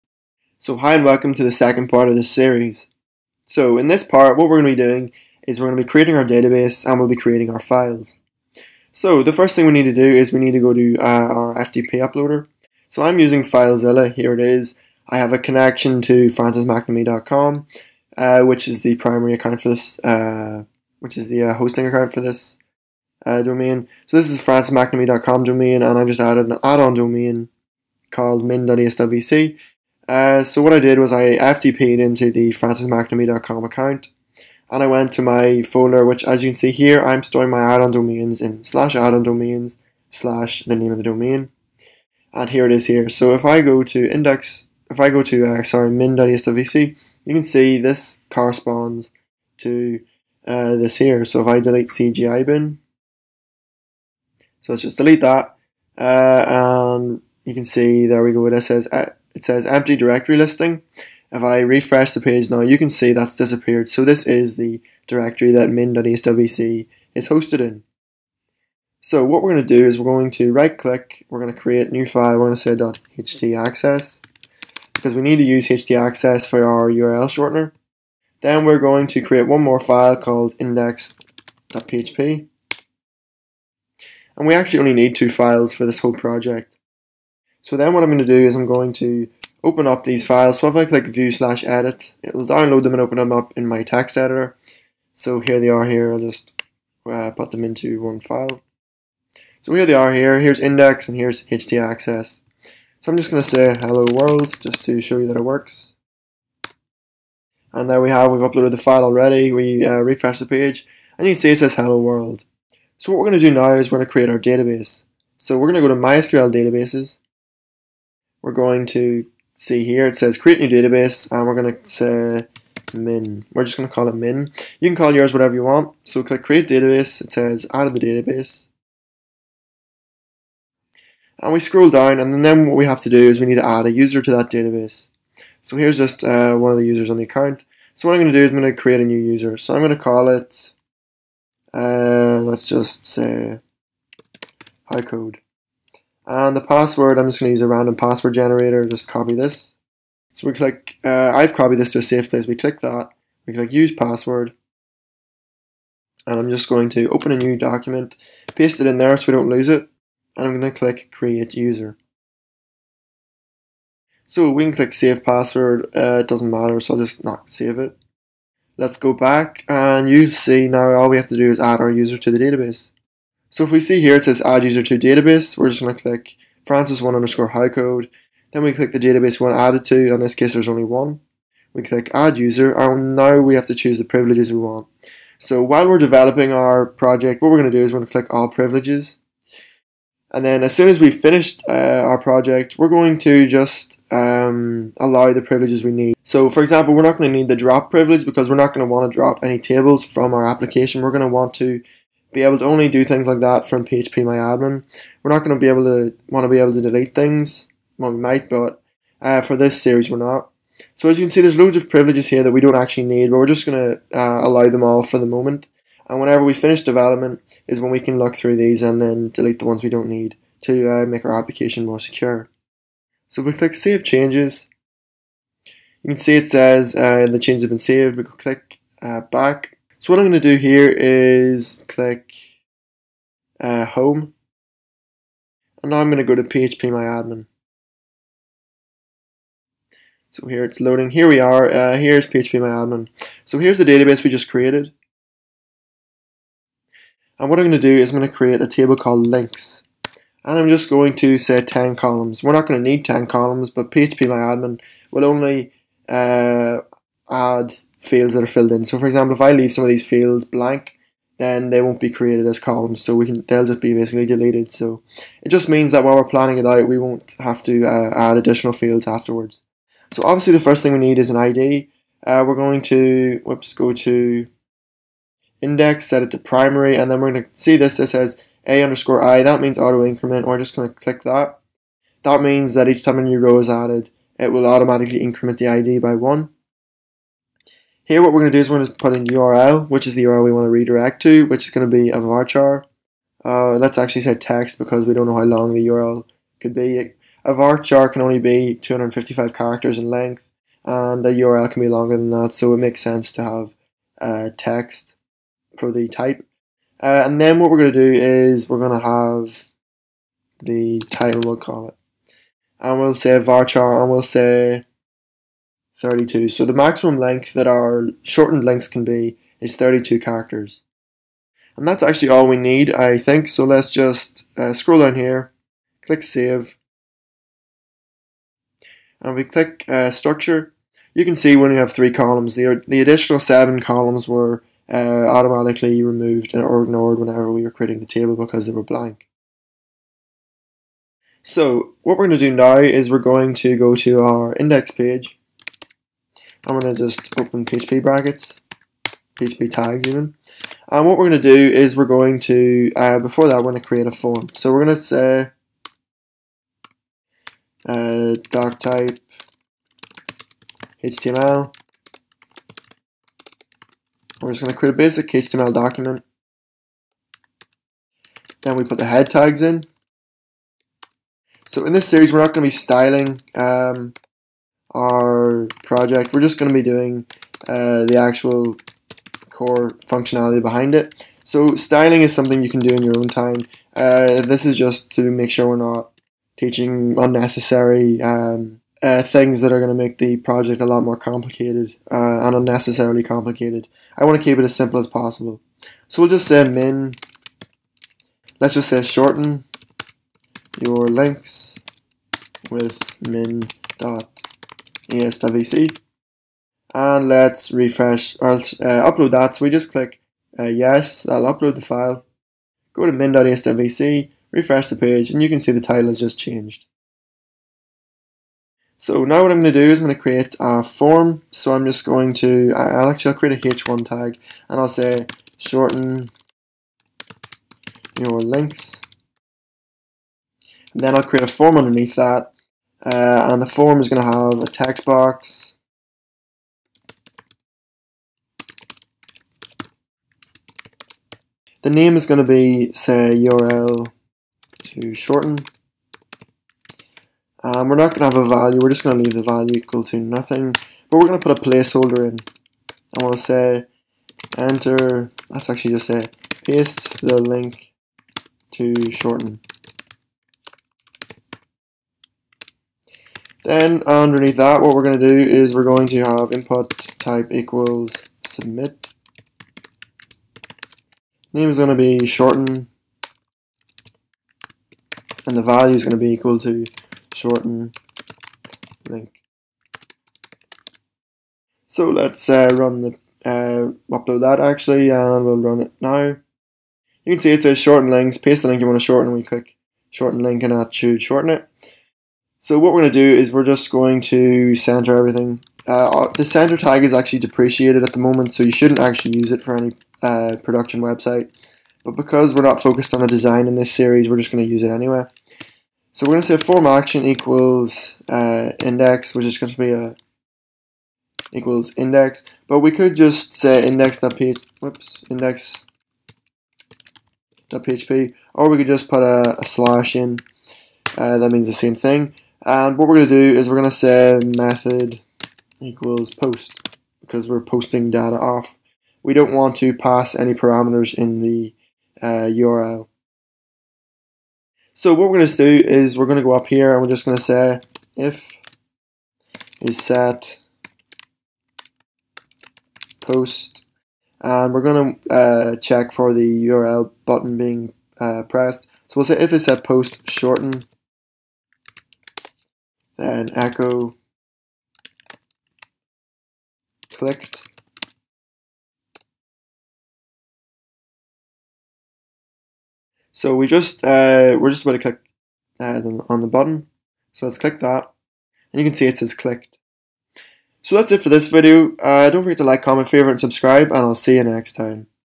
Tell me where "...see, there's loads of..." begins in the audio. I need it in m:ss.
3:31.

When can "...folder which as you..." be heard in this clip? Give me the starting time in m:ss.
0:35.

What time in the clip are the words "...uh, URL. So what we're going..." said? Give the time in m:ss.
8:52.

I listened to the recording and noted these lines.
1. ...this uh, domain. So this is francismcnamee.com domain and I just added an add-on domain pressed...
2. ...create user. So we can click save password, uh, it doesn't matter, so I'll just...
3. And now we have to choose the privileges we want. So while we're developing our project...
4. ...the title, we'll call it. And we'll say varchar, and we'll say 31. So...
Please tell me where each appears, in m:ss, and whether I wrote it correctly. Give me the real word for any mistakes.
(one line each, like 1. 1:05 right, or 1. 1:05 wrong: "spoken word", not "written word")
1. 0:22 wrong: "called", not "pressed"
2. 2:41 right
3. 3:02 right
4. 5:10 wrong: "32", not "31".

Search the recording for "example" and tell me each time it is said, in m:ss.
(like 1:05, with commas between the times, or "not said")
3:16, 4:19.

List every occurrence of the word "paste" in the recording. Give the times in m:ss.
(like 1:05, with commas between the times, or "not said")
2:38, 7:36, 8:08.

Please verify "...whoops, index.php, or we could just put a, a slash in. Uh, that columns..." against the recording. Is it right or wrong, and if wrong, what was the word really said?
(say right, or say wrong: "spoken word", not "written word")
wrong: "means", not "columns".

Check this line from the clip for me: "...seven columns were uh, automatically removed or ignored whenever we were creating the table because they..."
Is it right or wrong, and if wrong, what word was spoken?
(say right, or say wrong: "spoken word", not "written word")
right.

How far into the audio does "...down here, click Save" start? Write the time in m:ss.
5:24.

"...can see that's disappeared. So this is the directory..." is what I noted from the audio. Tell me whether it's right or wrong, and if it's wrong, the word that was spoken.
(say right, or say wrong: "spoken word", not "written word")
right.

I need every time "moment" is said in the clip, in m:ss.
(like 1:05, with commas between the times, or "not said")
3:35, 8:18.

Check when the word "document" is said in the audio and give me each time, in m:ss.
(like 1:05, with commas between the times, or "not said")
2:37, 6:05.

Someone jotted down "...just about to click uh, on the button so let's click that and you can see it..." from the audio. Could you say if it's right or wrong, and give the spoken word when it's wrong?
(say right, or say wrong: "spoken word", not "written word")
right.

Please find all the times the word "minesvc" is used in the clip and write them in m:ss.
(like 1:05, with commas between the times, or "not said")
0:45, 6:53.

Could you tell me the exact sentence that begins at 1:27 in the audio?
So then what I'm going to do is I'm going to open up these files.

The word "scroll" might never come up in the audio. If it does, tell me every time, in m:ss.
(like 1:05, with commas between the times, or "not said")
2:11, 5:24.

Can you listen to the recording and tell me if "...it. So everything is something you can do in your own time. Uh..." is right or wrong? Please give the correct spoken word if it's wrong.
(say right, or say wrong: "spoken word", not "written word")
wrong: "styling", not "everything".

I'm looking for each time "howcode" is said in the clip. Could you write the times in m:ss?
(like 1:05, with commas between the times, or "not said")
2:24, 2:57.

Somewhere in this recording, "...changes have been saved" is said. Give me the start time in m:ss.
3:47.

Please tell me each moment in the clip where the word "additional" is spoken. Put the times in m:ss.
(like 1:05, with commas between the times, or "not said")
4:28, 5:33.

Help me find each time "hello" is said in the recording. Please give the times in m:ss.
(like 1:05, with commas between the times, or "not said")
1:43, 1:51.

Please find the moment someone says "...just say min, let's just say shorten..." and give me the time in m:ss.
6:36.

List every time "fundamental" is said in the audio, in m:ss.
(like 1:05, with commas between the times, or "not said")
not said.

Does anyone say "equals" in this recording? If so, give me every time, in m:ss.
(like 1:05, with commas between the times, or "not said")
7:29, 7:47, 7:56, 8:27, 8:31, 8:45.